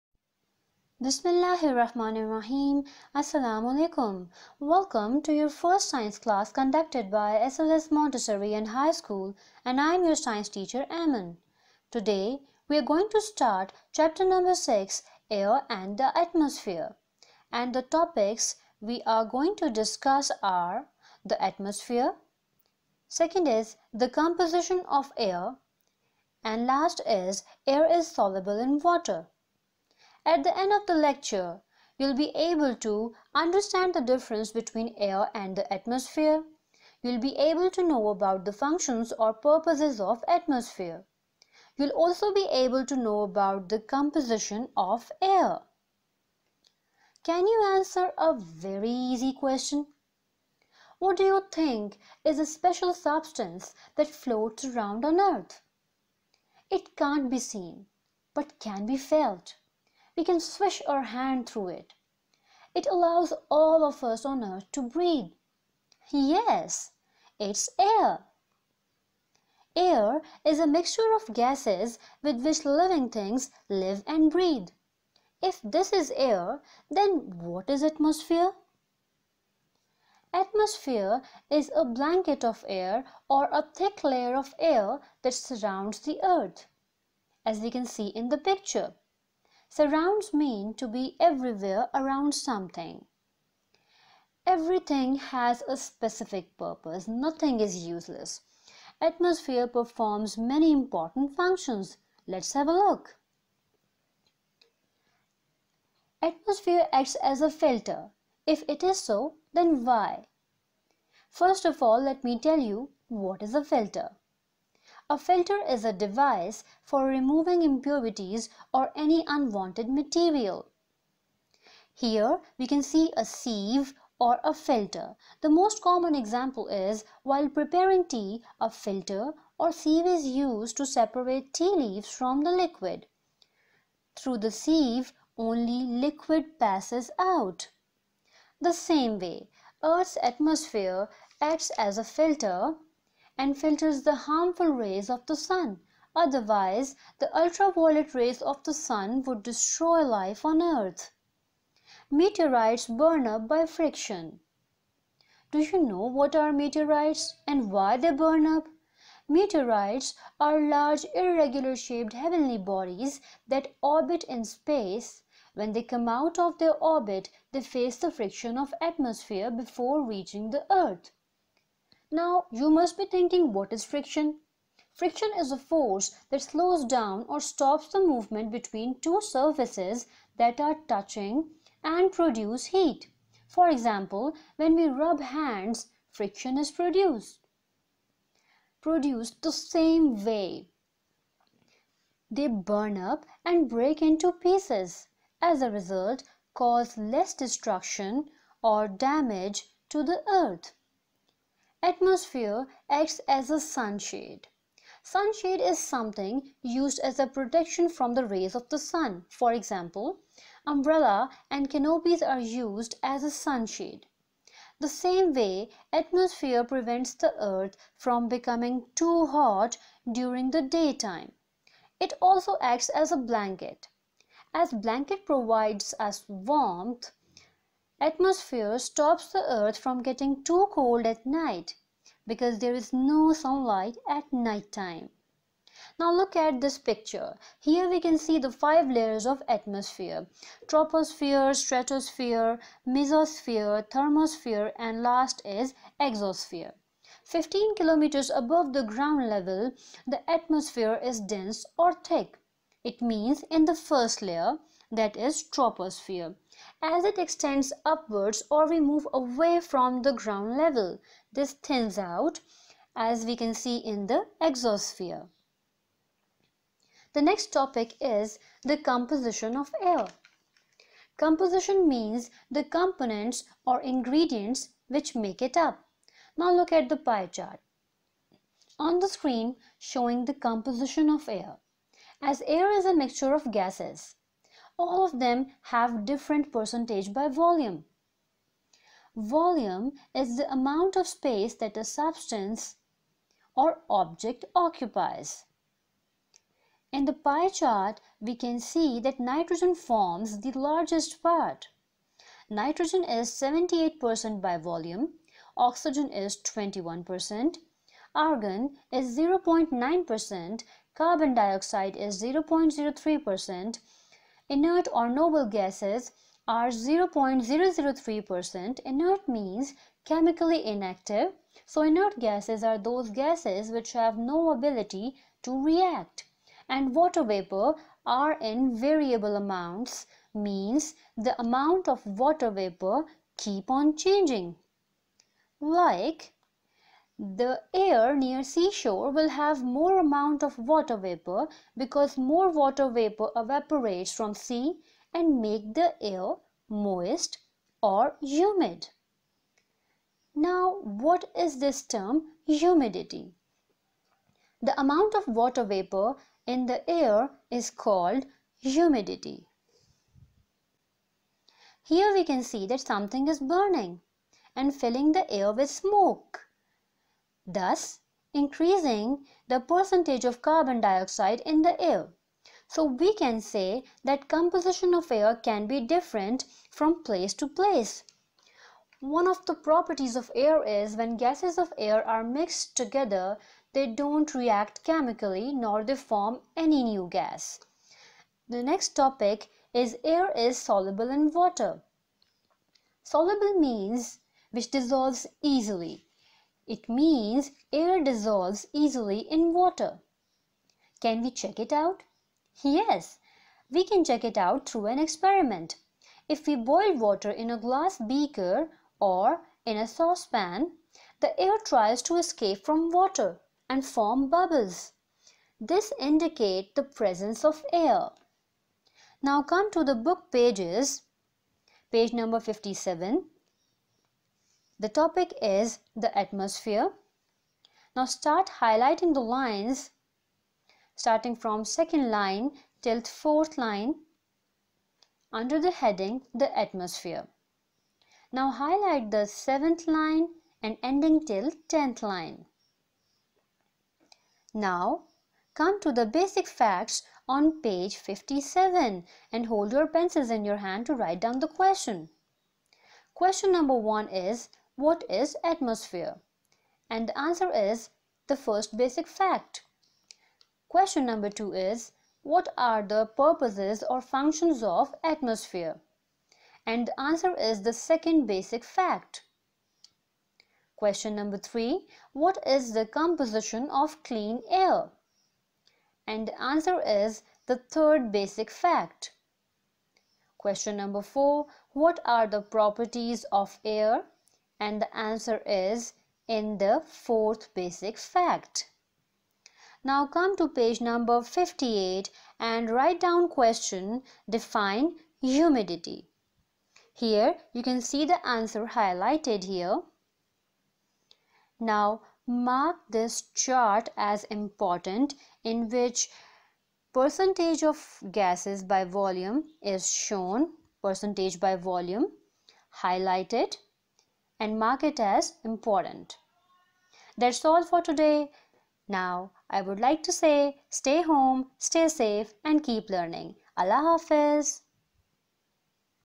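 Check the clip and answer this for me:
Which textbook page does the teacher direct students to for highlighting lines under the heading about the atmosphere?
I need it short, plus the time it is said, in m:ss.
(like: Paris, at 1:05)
57, at 7:01.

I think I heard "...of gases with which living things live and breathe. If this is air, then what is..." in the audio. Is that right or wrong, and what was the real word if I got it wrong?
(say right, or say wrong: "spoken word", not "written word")
right.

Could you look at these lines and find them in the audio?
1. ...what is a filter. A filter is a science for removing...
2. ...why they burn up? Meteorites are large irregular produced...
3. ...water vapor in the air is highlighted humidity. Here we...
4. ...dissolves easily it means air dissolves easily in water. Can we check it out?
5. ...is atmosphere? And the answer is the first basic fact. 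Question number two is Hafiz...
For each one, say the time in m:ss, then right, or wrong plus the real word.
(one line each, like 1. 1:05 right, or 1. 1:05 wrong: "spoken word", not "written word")
1. 1:53 wrong: "device", not "science"
2. 2:37 wrong: "shaped", not "produced"
3. 5:55 wrong: "called", not "highlighted"
4. 6:34 right
5. 7:35 wrong: "What", not "Hafiz".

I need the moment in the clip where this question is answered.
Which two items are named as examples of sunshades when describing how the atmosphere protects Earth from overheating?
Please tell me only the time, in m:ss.
3:30.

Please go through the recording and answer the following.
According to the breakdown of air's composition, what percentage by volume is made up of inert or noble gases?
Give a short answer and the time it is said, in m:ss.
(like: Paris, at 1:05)
0.003%, at 5:16.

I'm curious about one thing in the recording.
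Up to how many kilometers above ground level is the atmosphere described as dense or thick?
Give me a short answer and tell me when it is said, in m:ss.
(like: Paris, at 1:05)
15 kilometers, at 4:07.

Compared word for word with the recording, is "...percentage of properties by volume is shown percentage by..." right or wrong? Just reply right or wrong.
wrong.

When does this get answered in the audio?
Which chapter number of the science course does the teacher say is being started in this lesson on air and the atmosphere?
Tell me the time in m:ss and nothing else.
0:13.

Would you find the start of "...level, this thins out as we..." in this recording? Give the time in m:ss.
4:20.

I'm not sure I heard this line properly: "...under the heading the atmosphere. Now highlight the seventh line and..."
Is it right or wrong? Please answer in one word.
right.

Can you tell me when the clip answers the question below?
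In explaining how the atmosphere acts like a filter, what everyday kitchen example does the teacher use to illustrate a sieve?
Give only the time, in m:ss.
2:07.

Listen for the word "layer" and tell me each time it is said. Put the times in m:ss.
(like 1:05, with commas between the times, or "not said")
1:24, 3:58, 4:14.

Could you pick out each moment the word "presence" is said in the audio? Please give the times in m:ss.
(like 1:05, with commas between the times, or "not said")
6:56.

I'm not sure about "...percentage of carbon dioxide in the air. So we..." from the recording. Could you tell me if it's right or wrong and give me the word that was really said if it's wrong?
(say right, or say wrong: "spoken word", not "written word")
right.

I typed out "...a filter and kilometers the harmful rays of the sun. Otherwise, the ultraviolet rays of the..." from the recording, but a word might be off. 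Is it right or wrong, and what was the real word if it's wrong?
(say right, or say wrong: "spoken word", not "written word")
wrong: "filters", not "kilometers".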